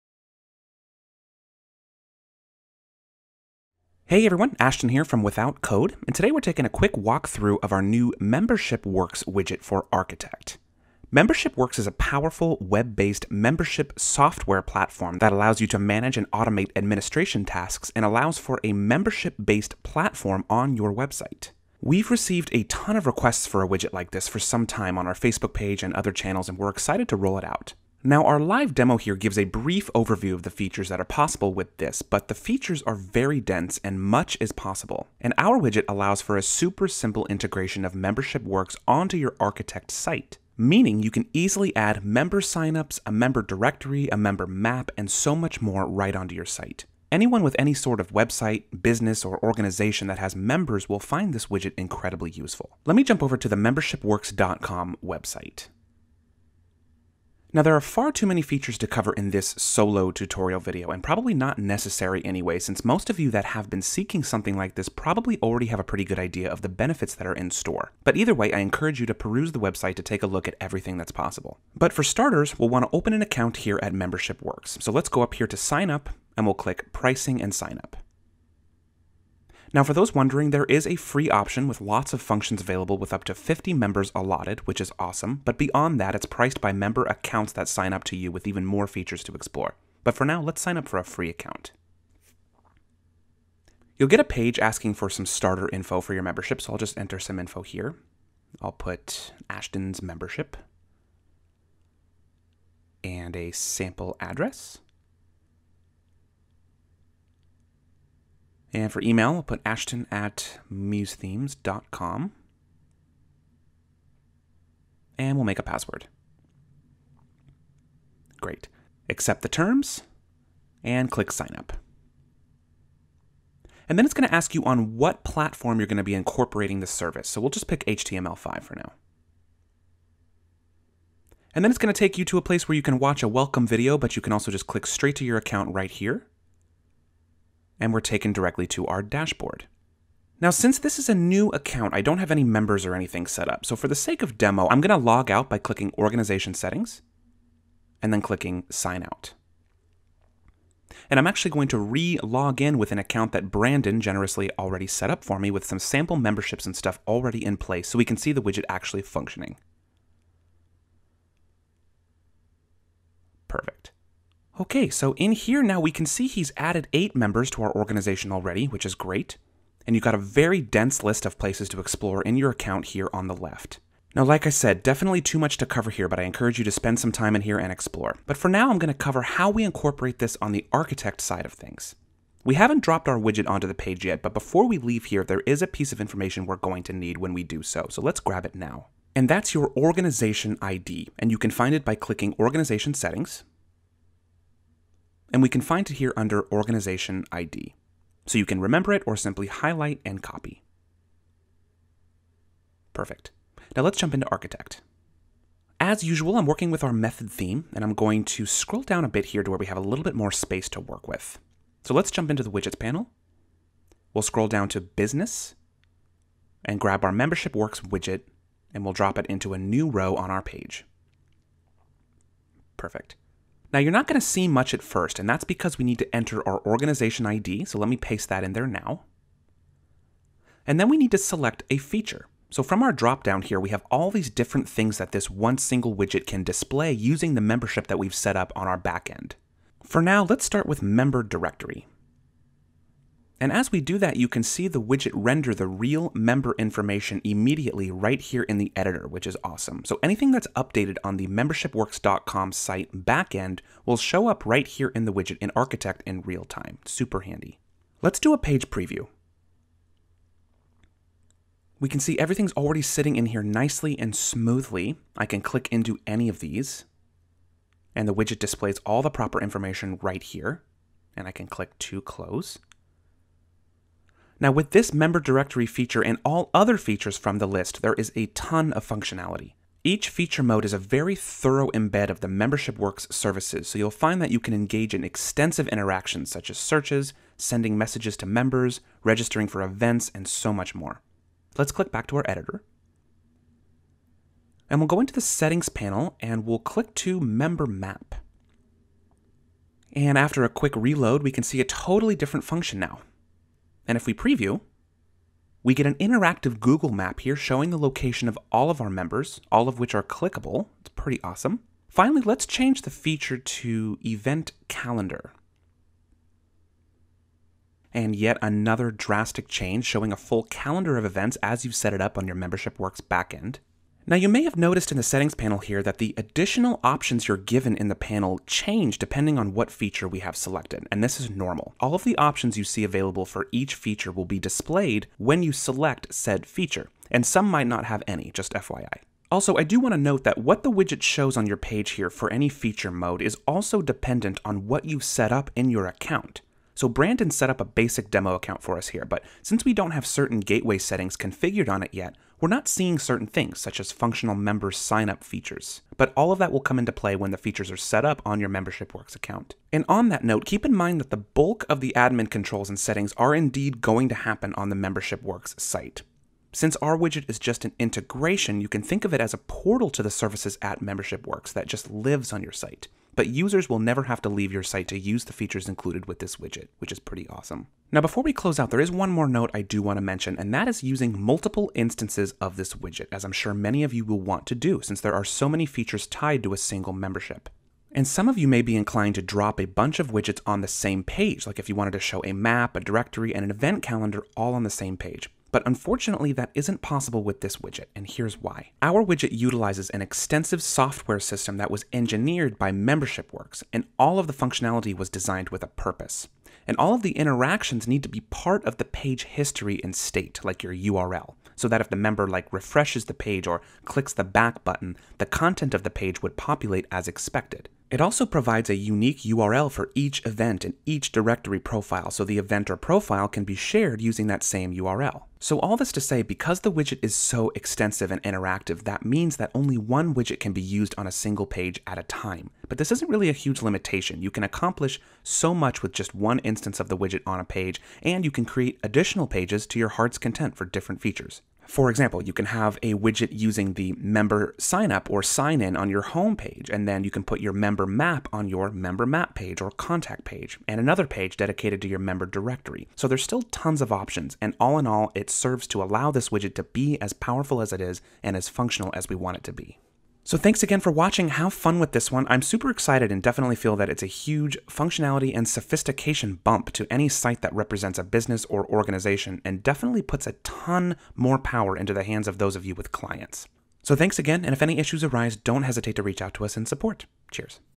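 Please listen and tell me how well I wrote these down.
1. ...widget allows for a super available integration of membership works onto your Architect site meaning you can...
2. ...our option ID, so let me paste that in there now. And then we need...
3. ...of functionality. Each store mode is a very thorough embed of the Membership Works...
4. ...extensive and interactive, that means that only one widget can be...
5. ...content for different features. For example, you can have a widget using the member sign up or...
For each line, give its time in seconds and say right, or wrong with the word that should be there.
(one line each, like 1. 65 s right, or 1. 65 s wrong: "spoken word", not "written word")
1. 35 s wrong: "simple", not "available"
2. 226 s wrong: "organization", not "option"
3. 278 s wrong: "feature", not "store"
4. 427 s right
5. 440 s right.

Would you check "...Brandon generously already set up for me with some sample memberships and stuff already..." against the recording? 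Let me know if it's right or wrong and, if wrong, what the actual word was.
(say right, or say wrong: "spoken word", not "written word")
right.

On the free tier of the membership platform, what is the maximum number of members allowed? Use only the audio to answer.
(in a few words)
50.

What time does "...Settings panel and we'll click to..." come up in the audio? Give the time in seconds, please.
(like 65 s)
295 s.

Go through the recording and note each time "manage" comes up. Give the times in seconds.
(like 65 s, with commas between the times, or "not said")
15 s.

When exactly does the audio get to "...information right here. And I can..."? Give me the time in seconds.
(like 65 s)
269 s.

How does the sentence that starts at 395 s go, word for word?
But unfortunately, that isn't possible with this widget, and here's why.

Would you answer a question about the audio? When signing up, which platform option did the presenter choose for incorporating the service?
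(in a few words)
HTML5.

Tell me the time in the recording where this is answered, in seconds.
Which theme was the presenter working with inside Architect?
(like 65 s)
206 s.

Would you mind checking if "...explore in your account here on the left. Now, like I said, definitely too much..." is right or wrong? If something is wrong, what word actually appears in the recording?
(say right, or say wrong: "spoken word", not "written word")
right.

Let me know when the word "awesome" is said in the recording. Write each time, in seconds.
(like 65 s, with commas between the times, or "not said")
84 s, 249 s, 311 s, 377 s.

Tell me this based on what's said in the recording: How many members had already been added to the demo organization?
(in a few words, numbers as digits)
8.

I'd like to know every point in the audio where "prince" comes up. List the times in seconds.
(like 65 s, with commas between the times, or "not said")
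not said.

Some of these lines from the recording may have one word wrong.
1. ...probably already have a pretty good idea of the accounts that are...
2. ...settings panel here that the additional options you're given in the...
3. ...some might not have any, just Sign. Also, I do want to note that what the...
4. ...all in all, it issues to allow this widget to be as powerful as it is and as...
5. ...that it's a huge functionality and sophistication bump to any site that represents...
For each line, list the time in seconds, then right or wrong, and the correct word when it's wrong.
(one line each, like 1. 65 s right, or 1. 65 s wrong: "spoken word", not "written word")
1. 64 s wrong: "benefits", not "accounts"
2. 325 s right
3. 337 s wrong: "FYI", not "Sign"
4. 454 s wrong: "serves", not "issues"
5. 463 s right.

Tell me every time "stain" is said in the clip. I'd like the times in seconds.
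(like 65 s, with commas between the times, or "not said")
not said.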